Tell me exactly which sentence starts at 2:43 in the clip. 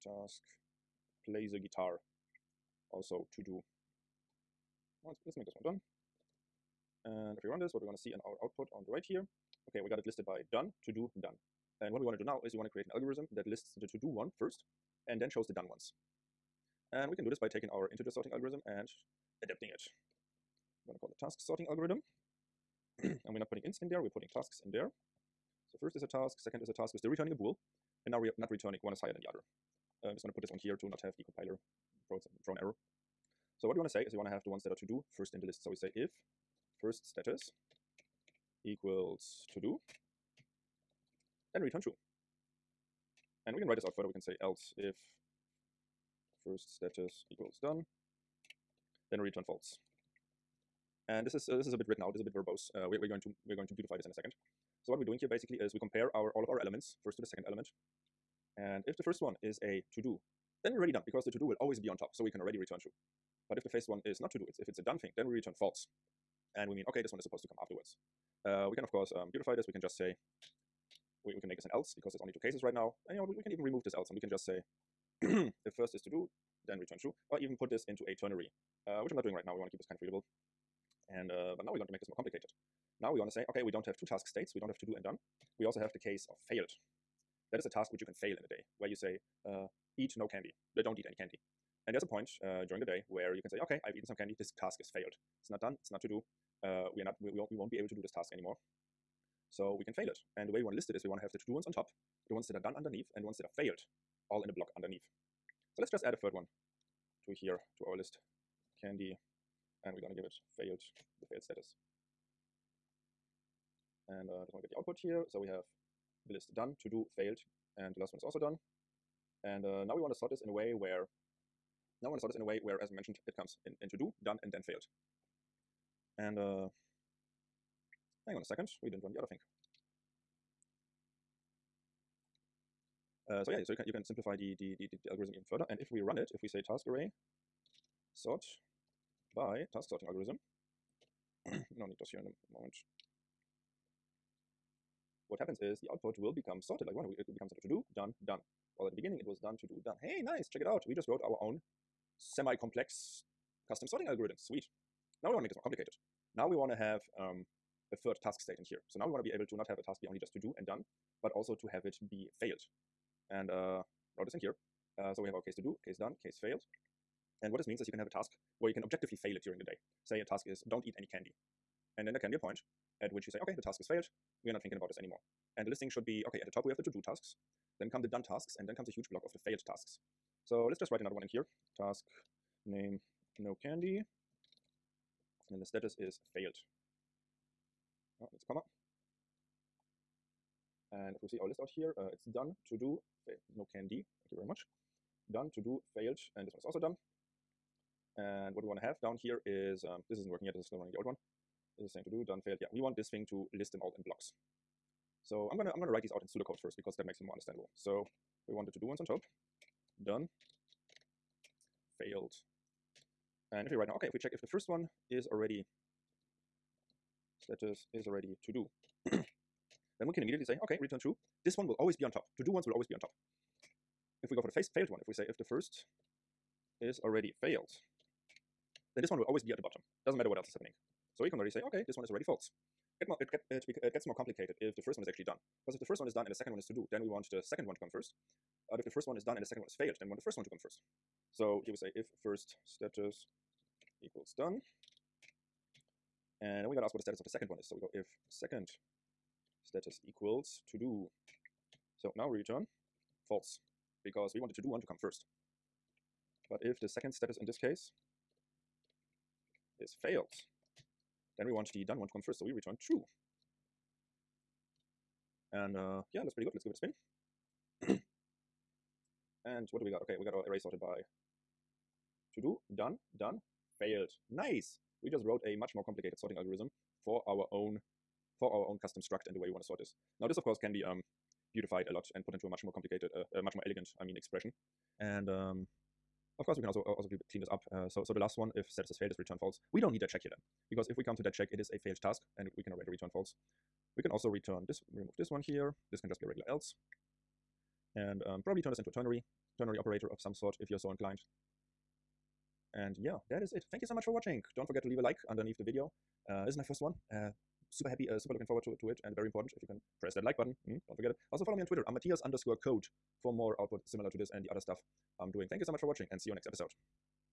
And uh, wrote this in here.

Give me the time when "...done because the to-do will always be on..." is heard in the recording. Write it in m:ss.
1:00.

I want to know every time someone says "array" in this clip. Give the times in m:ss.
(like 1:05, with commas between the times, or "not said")
2:16, 4:30.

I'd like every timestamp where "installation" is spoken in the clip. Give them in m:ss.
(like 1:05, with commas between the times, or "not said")
not said.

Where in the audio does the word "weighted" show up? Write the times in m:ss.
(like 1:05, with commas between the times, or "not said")
not said.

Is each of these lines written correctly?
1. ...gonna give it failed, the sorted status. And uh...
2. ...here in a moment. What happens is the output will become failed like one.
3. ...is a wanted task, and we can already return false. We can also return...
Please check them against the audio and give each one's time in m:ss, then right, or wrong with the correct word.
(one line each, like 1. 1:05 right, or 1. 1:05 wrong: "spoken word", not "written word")
1. 1:50 wrong: "failed", not "sorted"
2. 2:22 wrong: "sorted", not "failed"
3. 4:51 wrong: "failed", not "wanted".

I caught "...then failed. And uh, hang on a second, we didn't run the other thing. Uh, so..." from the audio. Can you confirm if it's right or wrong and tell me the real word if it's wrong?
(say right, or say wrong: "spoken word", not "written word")
right.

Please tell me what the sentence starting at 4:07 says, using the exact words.
So we go if second status equals to do.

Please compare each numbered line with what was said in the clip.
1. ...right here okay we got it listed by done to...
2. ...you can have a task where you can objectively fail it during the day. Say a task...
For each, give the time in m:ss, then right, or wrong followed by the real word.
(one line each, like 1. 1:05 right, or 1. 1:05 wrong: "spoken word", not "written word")
1. 0:08 right
2. 2:47 right.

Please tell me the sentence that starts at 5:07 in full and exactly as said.
Uh, super happy, uh, super looking forward to, to it, and very important if you can press that like button.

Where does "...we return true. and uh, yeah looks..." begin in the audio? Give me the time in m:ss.
4:22.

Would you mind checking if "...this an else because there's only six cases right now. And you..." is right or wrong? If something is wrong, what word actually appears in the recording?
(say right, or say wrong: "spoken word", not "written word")
wrong: "two", not "six".